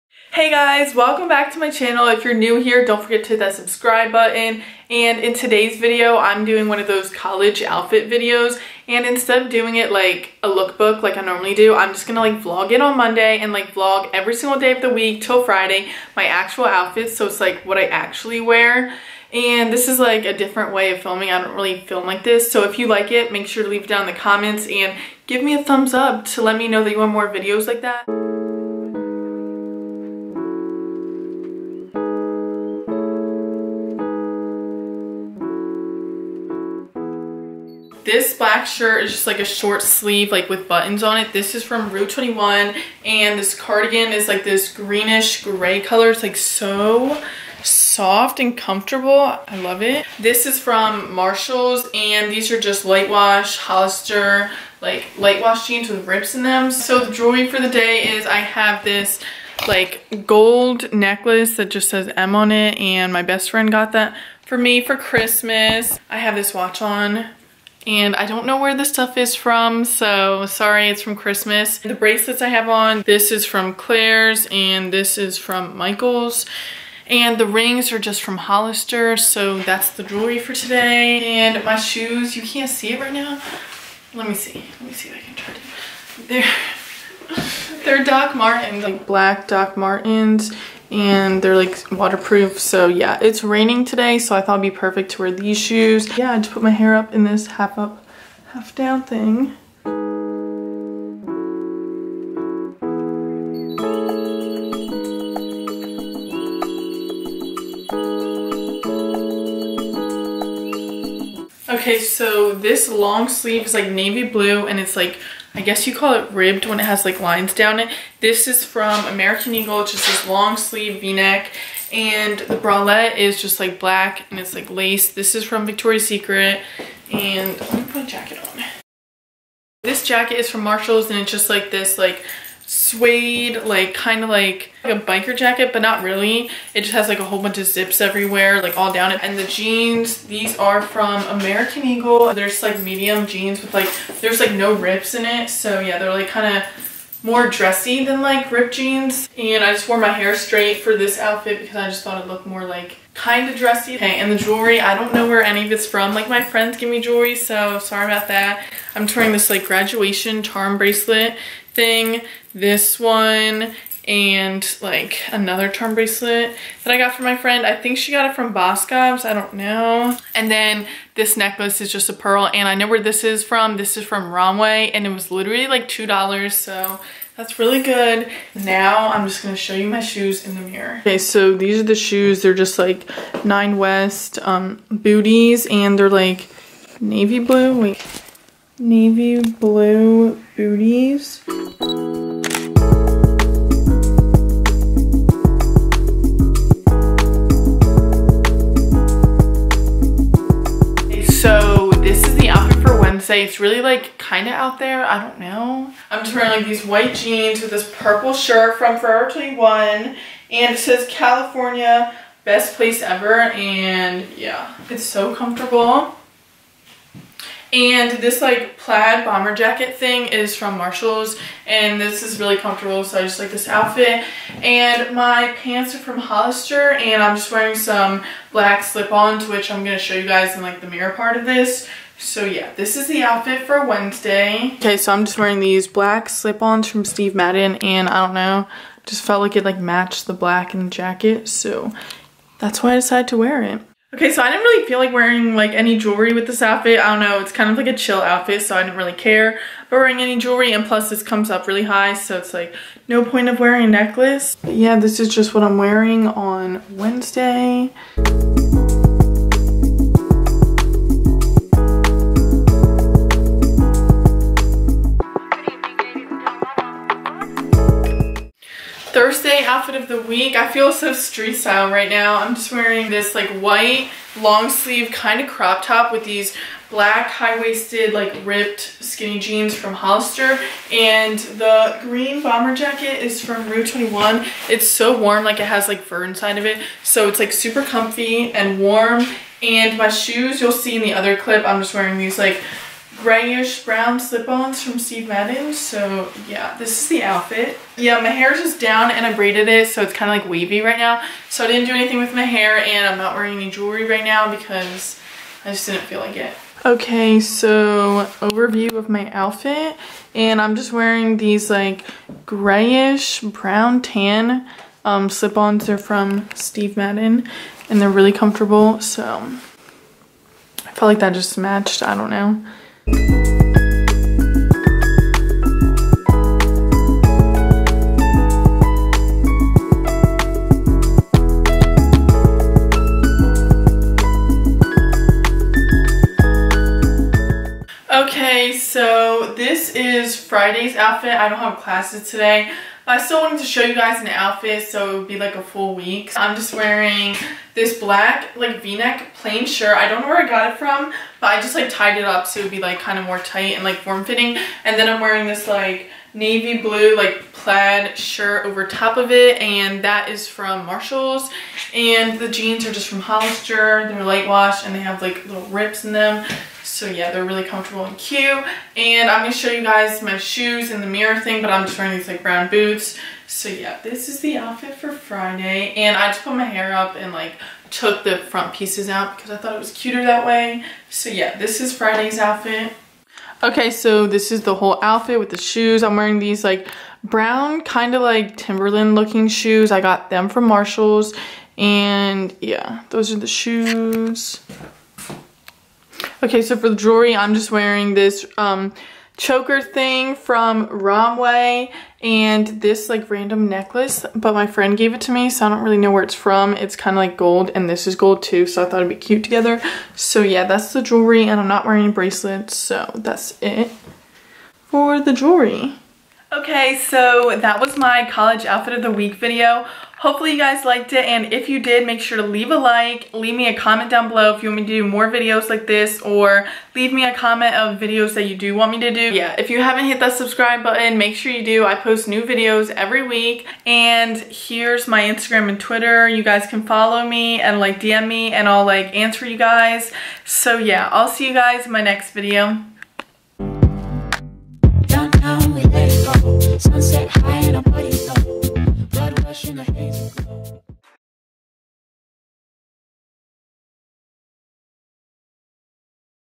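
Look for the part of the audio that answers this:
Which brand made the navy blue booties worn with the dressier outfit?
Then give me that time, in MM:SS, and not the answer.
03:02.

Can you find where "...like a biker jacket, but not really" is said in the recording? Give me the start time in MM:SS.
02:14.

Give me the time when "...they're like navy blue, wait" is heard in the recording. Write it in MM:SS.
03:05.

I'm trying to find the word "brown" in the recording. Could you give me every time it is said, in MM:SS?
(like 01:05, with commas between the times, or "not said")
04:53, 05:13, 06:12, 06:27.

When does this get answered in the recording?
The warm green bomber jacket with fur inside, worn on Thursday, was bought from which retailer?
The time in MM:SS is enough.
04:41.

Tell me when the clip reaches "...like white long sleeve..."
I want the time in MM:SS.
04:33.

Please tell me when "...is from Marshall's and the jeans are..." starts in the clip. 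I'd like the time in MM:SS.
06:00.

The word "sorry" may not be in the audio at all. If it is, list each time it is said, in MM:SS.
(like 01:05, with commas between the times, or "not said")
01:10, 02:37.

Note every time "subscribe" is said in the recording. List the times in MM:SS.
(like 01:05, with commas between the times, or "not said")
00:03, 07:10.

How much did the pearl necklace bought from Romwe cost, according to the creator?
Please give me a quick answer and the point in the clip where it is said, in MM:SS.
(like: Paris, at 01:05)
$2, at 02:55.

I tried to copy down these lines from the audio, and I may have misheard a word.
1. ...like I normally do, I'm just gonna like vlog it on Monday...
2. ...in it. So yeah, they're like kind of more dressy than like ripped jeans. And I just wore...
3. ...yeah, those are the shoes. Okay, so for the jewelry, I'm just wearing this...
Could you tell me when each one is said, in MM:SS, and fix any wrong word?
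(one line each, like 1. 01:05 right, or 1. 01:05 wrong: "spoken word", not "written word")
1. 00:11 right
2. 02:25 right
3. 06:32 right.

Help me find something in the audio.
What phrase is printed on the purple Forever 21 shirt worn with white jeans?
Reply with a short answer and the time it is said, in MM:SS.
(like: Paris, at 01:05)
California best place ever, at 03:30.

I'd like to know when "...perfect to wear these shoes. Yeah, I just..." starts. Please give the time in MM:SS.
01:34.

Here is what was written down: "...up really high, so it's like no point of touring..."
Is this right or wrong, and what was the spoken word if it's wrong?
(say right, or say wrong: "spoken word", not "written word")
wrong: "wearing", not "touring".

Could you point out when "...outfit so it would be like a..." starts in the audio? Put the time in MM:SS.
05:44.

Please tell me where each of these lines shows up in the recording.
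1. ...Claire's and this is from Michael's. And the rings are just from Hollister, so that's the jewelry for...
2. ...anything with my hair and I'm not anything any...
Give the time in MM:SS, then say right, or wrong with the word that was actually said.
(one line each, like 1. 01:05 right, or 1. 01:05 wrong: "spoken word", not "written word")
1. 01:13 right
2. 05:01 wrong: "wearing", not "anything".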